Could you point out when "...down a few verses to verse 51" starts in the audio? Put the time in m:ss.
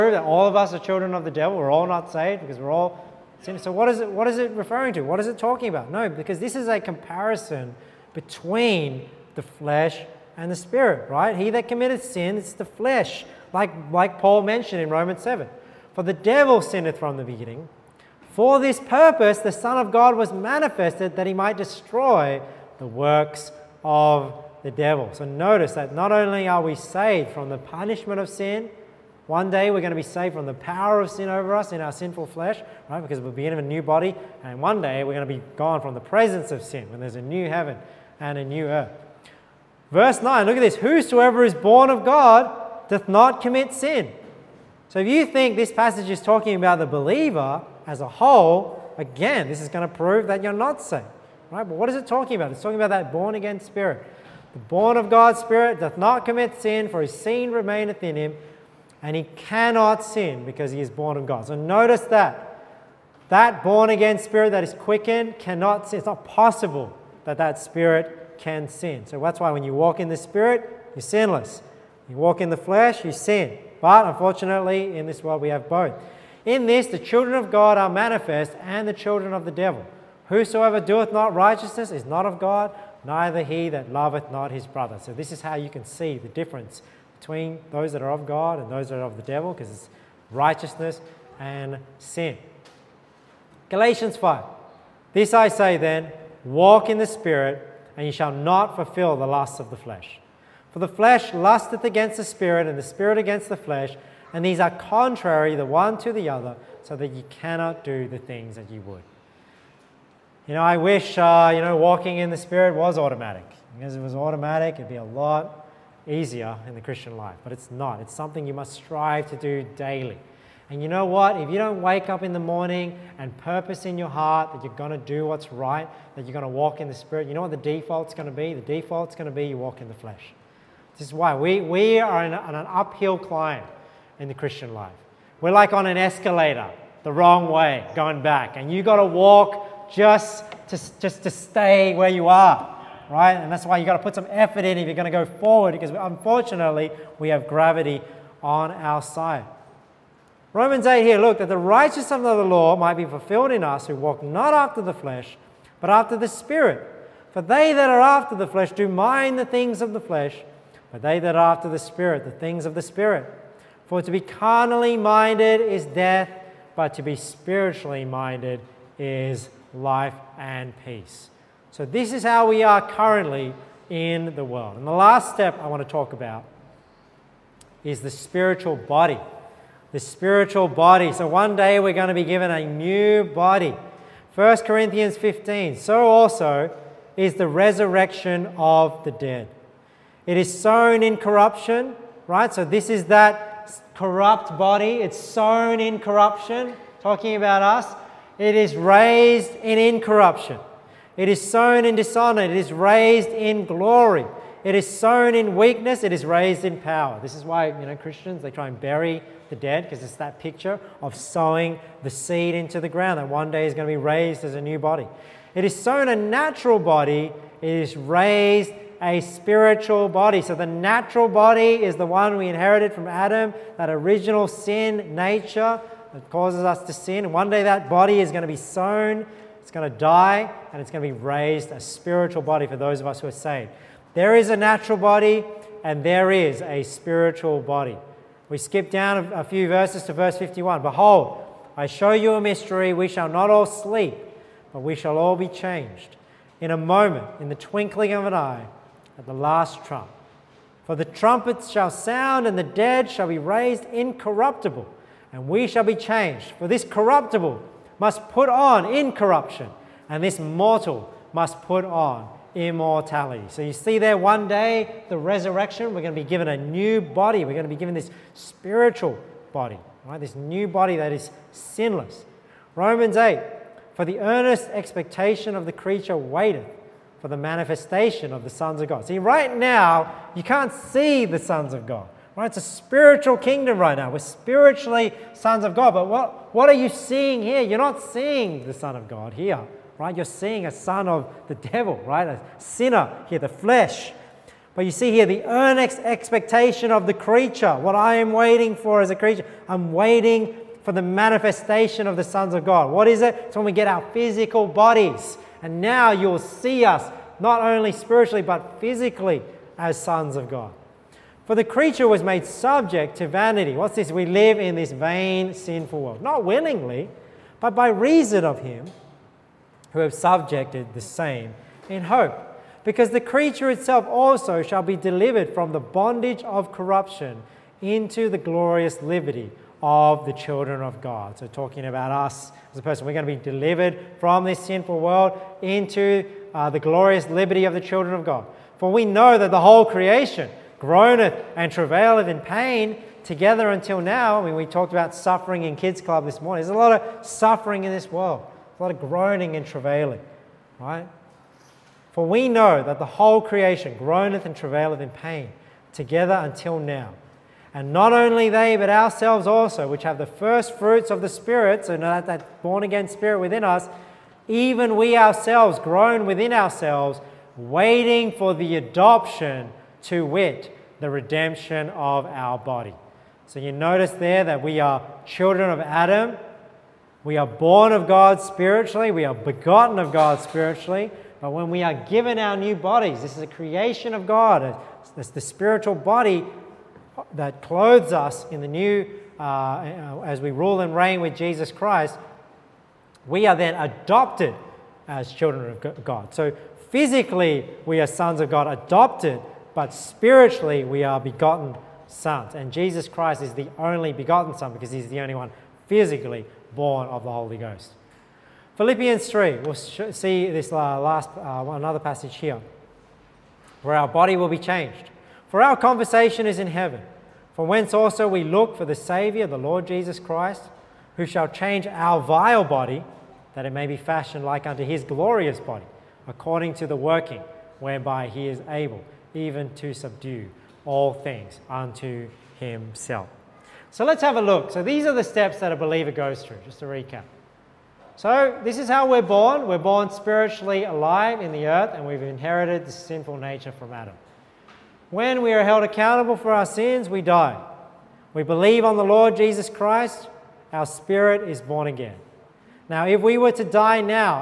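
3:58.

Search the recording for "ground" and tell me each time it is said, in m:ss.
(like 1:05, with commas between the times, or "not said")
3:32.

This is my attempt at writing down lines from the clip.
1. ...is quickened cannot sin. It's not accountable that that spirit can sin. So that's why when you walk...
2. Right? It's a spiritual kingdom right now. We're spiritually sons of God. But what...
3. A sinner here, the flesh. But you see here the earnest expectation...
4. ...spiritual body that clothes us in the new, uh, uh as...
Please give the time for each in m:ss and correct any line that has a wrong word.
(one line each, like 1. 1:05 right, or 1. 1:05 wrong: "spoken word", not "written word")
1. 1:04 wrong: "possible", not "accountable"
2. 4:42 right
3. 4:52 right
4. 6:25 right.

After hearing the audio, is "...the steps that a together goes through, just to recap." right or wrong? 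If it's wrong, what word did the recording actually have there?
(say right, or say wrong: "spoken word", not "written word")
wrong: "believer", not "together".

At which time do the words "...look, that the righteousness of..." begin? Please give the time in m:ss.
2:31.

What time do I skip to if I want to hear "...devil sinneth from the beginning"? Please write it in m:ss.
0:16.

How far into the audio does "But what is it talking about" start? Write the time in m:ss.
0:51.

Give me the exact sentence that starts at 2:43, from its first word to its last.
For to be carnally minded is death, but to be spiritually minded is life and peace.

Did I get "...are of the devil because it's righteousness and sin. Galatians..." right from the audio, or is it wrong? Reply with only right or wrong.
right.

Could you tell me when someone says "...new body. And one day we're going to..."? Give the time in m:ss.
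0:33.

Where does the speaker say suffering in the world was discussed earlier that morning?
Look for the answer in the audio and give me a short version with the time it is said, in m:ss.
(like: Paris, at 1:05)
Kids Club, at 5:45.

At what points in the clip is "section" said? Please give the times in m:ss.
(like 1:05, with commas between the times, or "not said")
not said.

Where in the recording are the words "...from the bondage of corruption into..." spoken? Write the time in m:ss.
5:25.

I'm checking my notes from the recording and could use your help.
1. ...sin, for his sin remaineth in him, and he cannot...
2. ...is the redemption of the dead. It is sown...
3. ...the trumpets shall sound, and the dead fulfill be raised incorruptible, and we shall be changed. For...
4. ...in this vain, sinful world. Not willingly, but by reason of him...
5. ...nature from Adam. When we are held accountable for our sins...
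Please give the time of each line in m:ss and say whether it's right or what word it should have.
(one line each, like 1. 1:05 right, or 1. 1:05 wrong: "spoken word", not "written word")
1. 0:56 right
2. 3:07 wrong: "resurrection", not "redemption"
3. 4:10 wrong: "shall", not "fulfill"
4. 5:14 right
5. 7:23 right.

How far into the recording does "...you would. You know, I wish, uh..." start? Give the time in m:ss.
1:48.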